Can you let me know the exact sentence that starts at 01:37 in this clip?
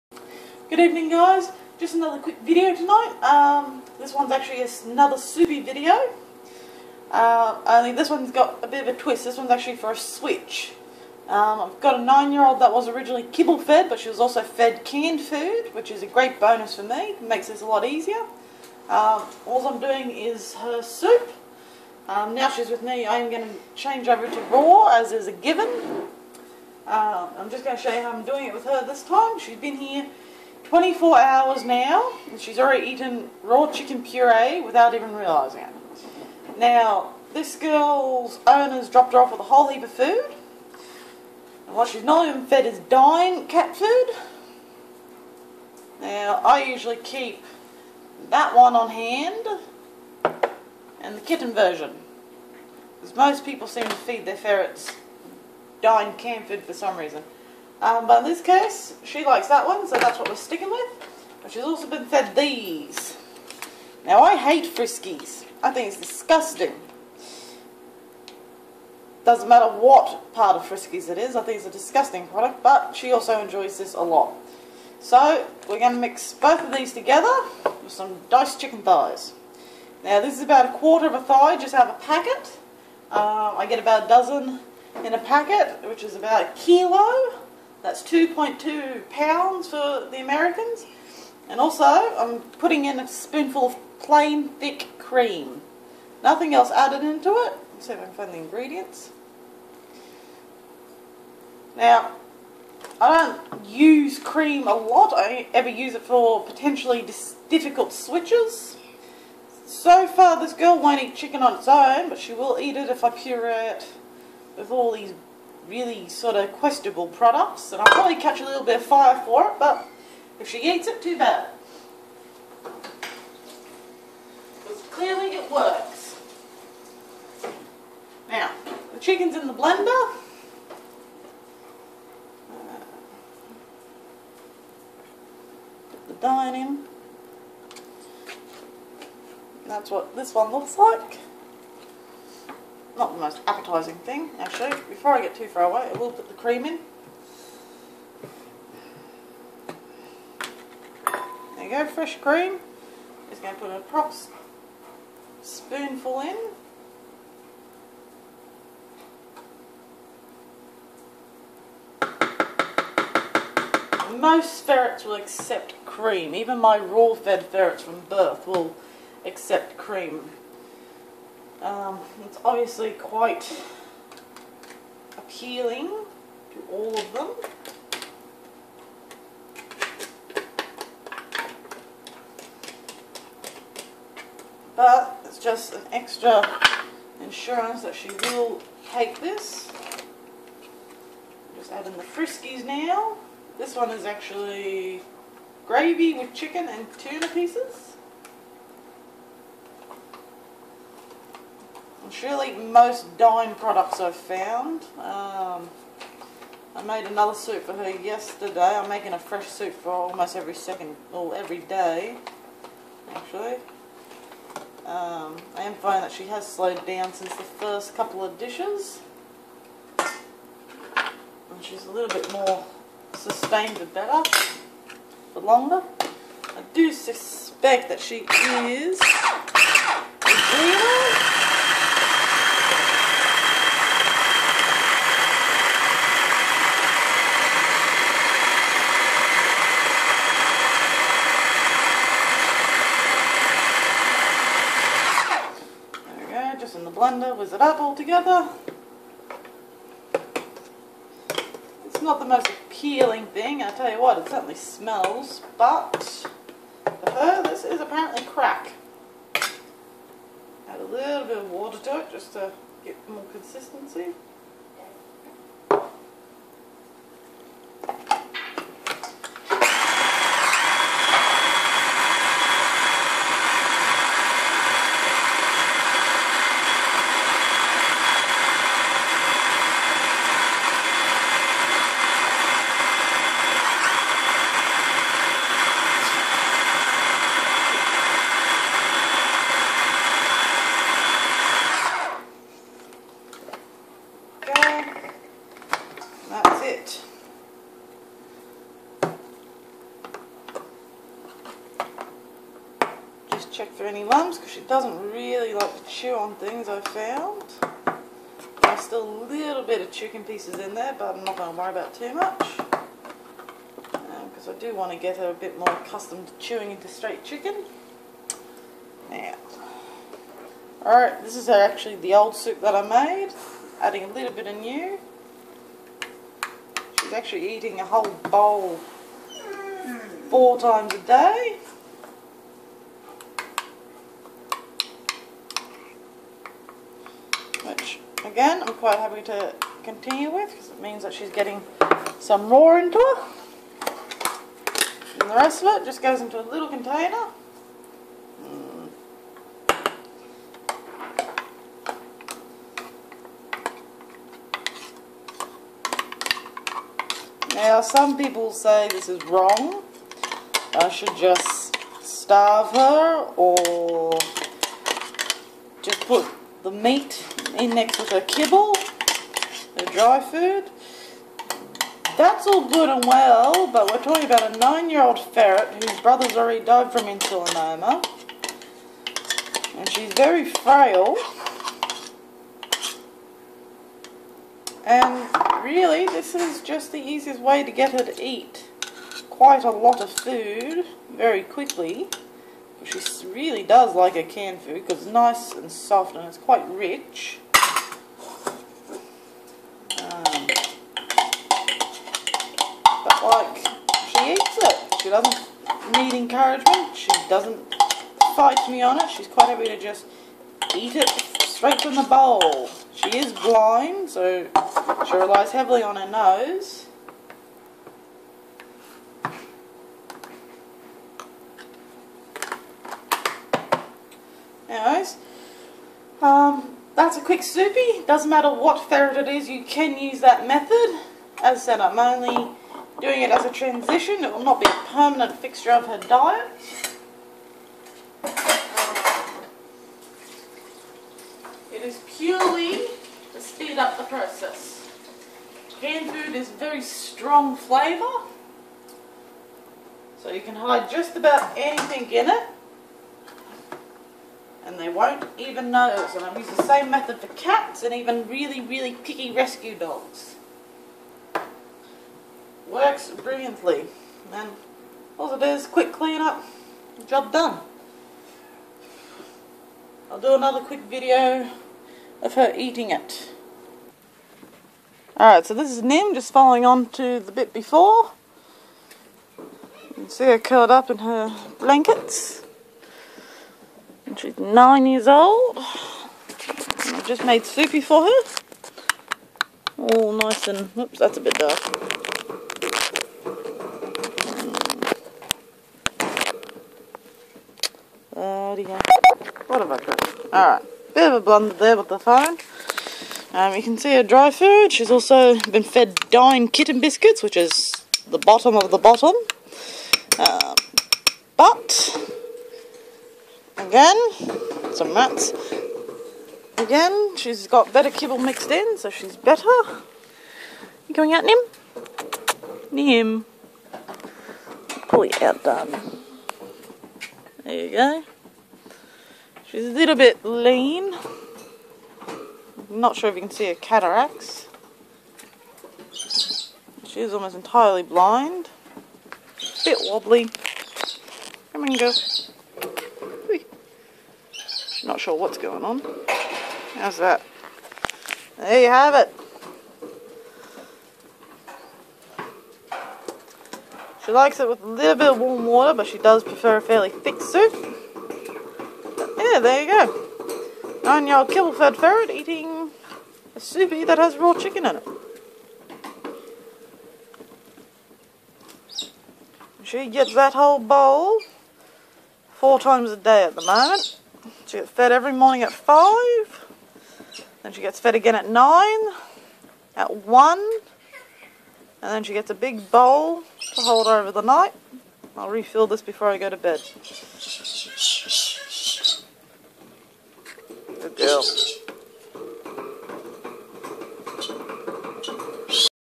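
Let's see if I can find the ingredients.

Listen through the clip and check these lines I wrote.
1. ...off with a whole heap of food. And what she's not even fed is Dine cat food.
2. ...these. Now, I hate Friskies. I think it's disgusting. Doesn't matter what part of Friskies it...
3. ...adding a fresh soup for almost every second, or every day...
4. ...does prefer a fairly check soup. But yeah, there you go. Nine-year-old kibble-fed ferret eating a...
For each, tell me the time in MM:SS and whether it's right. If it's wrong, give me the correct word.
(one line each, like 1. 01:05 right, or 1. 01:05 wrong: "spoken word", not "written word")
1. 00:39 right
2. 01:02 right
3. 03:28 wrong: "making", not "adding"
4. 09:15 wrong: "thick", not "check".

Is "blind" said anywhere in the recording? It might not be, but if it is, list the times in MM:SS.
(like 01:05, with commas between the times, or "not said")
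06:53, 08:57.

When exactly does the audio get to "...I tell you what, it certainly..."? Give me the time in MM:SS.
04:13.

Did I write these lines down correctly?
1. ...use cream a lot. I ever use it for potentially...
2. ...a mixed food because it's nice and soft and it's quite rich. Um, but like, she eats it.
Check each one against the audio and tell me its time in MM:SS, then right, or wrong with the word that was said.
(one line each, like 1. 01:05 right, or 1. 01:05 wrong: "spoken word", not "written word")
1. 01:43 right
2. 06:34 wrong: "canned", not "mixed".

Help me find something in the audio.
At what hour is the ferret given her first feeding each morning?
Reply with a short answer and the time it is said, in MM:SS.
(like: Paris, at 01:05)
5, at 09:35.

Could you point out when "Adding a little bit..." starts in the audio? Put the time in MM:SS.
05:23.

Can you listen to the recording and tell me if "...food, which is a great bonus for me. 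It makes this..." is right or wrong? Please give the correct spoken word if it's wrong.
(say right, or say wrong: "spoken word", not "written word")
right.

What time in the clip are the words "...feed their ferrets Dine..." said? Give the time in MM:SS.
00:53.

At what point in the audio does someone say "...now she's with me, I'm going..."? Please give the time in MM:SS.
00:22.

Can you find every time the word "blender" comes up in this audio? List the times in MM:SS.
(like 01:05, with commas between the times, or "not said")
02:09, 04:07.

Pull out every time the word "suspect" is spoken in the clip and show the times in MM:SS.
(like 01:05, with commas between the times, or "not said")
03:46.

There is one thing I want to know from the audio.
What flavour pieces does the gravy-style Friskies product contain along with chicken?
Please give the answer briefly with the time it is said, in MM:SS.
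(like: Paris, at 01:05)
tuna, at 03:16.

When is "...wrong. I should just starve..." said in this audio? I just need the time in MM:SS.
05:59.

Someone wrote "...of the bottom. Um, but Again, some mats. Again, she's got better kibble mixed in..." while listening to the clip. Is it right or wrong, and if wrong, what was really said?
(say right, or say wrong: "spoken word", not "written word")
right.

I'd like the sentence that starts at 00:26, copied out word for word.
Uh, I'm just going to show you how I'm doing it with her this time.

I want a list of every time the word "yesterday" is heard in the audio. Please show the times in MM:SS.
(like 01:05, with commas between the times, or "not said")
03:27.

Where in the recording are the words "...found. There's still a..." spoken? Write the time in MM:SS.
05:06.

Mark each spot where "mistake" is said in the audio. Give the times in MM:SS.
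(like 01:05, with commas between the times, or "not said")
not said.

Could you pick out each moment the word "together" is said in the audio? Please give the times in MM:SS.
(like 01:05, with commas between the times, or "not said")
01:16, 04:07.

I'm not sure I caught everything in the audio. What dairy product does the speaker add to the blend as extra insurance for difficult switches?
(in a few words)
plain thick cream.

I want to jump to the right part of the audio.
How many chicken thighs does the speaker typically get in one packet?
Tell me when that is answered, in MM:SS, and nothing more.
01:23.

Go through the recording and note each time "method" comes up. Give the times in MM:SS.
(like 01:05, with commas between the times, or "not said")
07:10, 07:36.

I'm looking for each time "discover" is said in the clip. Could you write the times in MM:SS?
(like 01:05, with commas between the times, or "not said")
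not said.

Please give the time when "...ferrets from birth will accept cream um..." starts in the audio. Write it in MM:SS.
02:47.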